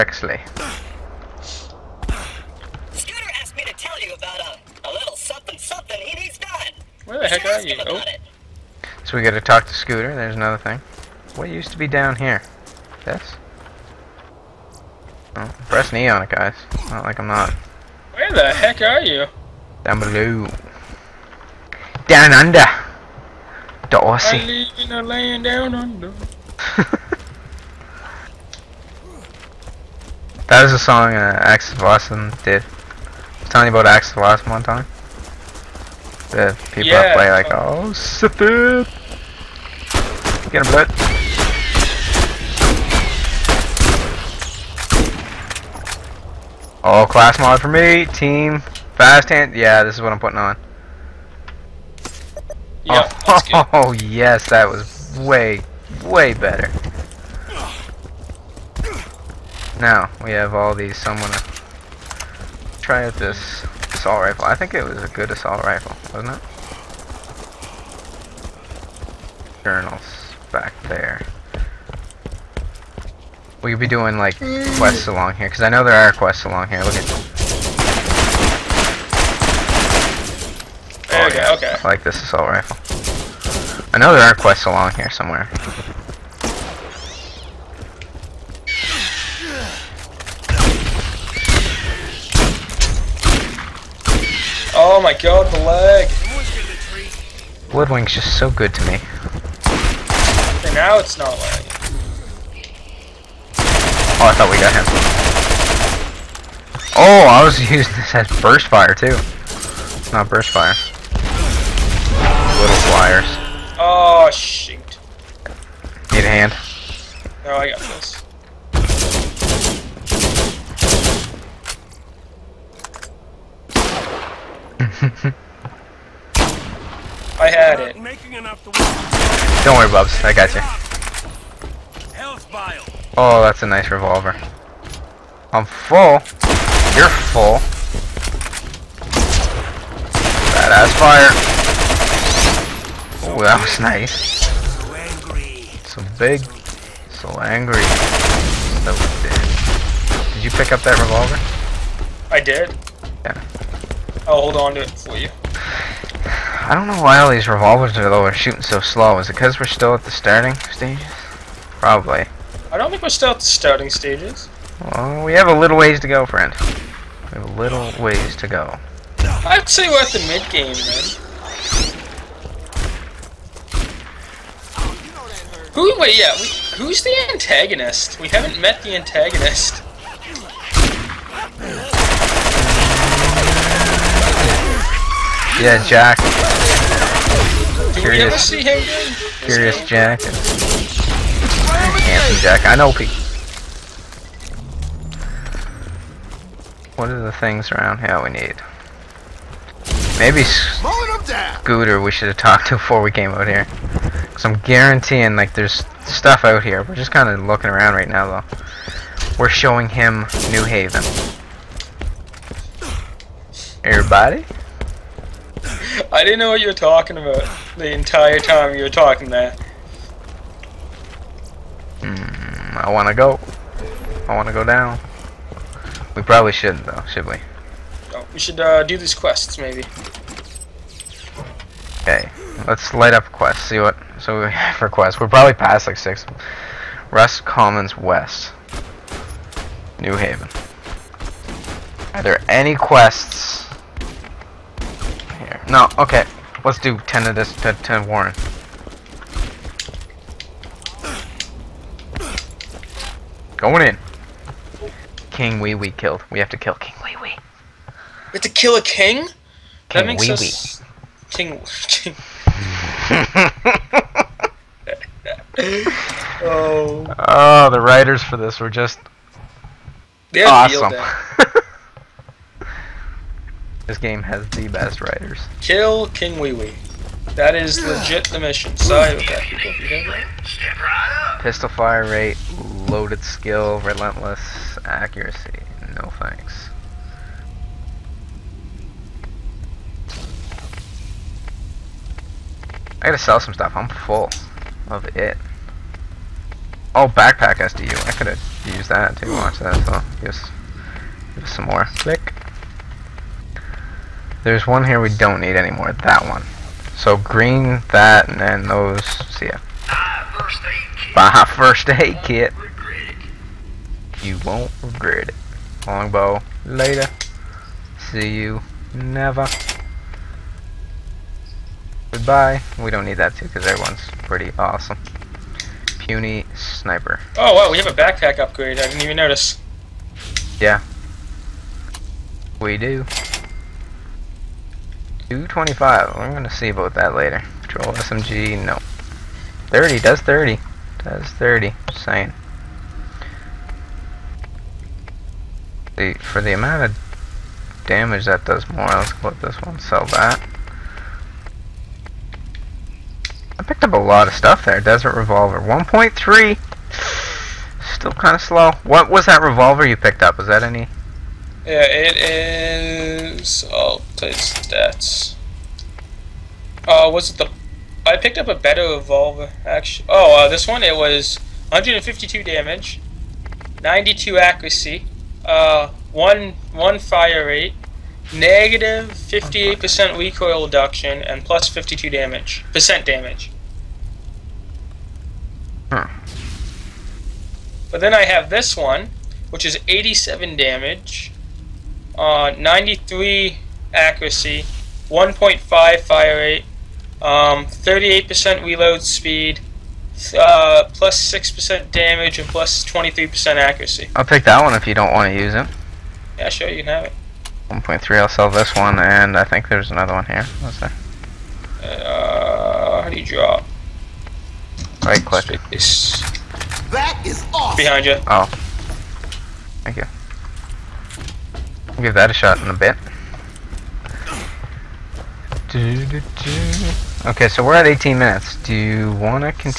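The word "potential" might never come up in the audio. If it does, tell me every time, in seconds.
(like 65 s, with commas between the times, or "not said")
not said.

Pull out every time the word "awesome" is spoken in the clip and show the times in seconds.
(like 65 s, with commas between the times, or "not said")
270 s, 324 s, 417 s.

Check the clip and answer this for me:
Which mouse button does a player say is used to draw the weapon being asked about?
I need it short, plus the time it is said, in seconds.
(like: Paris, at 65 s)
Right click, at 415 s.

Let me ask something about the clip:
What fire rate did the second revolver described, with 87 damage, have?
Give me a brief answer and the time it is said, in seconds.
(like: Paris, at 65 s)
1.5, at 395 s.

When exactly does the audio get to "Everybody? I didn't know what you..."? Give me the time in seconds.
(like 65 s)
213 s.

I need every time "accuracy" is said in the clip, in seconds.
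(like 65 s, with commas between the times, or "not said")
284 s, 374 s, 393 s, 403 s.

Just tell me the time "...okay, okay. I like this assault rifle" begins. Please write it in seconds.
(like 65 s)
81 s.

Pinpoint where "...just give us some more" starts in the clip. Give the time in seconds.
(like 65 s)
300 s.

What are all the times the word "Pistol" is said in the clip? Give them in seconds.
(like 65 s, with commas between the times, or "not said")
281 s.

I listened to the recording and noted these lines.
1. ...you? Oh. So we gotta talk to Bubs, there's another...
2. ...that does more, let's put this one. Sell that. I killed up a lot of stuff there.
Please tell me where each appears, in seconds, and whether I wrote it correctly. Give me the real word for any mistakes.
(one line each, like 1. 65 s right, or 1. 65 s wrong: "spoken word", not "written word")
1. 7 s wrong: "Scooter", not "Bubs"
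2. 348 s wrong: "picked", not "killed".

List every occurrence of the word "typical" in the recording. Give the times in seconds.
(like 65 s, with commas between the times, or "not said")
not said.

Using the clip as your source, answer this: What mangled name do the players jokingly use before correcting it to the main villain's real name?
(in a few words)
Curious Jack.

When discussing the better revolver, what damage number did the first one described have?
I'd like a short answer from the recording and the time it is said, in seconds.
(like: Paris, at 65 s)
152, at 371 s.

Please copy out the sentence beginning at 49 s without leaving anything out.
Yeah, this is what I'm putting on.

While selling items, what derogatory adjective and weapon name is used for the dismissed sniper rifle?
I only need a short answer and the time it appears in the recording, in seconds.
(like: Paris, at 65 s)
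Puny sniper, at 325 s.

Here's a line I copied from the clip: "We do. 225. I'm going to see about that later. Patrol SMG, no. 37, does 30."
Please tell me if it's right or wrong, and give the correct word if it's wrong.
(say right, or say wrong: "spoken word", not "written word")
wrong: "30", not "37".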